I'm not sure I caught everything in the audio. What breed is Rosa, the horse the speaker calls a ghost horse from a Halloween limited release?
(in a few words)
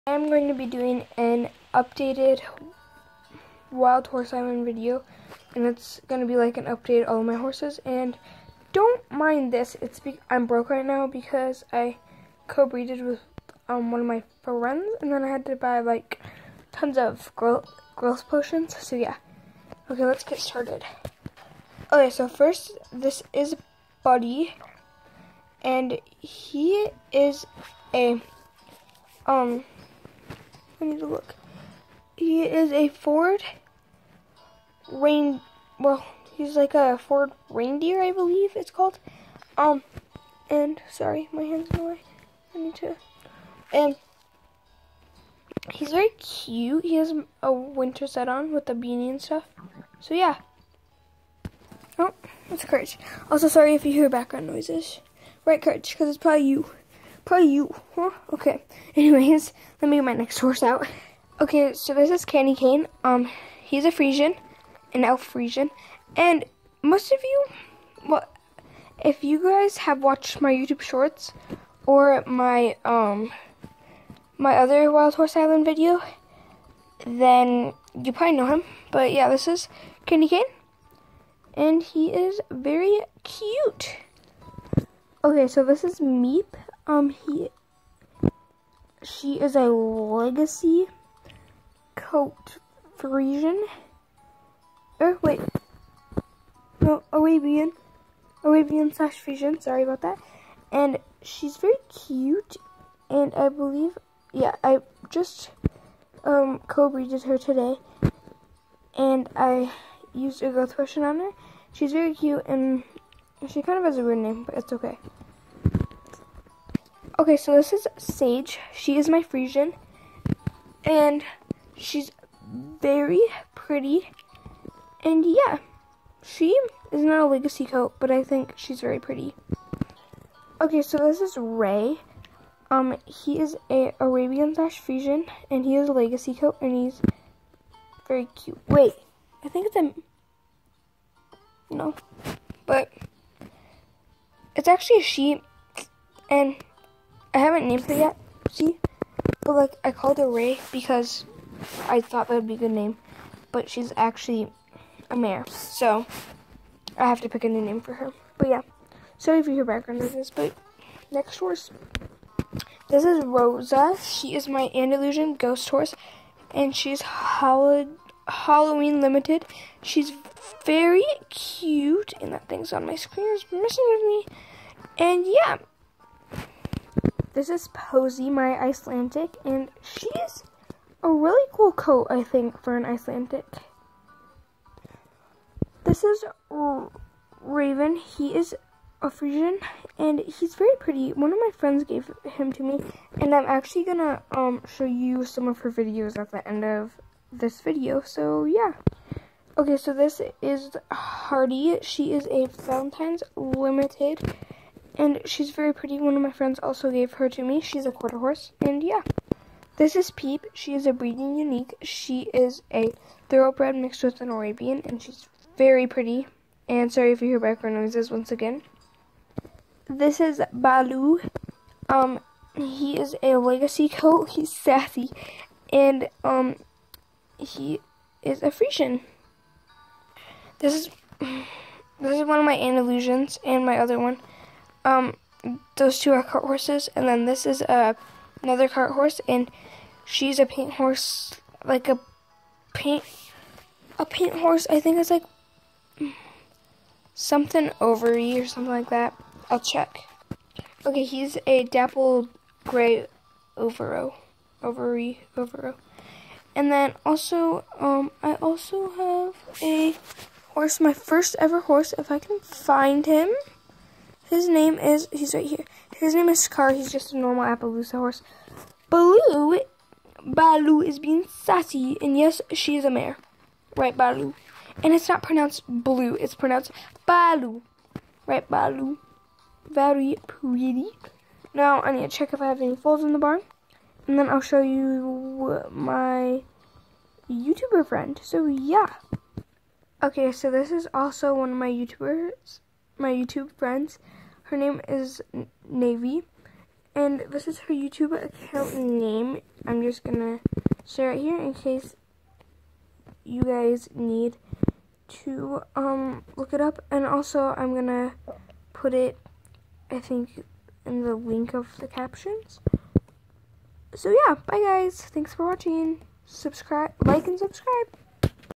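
Andalusian.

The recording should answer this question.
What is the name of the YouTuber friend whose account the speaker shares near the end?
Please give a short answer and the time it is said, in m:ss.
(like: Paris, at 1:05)
Navy, at 4:55.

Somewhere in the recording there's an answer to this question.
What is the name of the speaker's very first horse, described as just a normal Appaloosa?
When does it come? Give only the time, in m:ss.
4:26.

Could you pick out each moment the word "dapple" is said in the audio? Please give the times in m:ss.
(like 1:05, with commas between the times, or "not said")
4:11.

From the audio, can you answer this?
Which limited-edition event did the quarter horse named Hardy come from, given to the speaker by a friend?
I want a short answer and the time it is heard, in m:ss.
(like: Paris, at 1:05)
Valentine's, at 3:22.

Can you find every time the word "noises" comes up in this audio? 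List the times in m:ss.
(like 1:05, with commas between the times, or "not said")
0:54, 2:40, 3:37.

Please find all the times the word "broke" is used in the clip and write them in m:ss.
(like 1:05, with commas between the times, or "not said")
0:10.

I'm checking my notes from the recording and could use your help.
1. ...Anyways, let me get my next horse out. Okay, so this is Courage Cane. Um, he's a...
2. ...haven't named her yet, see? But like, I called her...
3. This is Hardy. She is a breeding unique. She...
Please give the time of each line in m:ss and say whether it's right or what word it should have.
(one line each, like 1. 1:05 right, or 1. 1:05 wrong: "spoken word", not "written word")
1. 0:58 wrong: "Candy", not "Courage"
2. 2:27 right
3. 3:29 wrong: "Peep", not "Hardy".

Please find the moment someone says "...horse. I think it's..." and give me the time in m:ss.
4:04.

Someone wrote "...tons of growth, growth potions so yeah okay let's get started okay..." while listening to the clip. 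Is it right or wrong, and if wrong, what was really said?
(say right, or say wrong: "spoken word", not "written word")
right.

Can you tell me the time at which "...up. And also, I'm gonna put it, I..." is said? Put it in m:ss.
5:06.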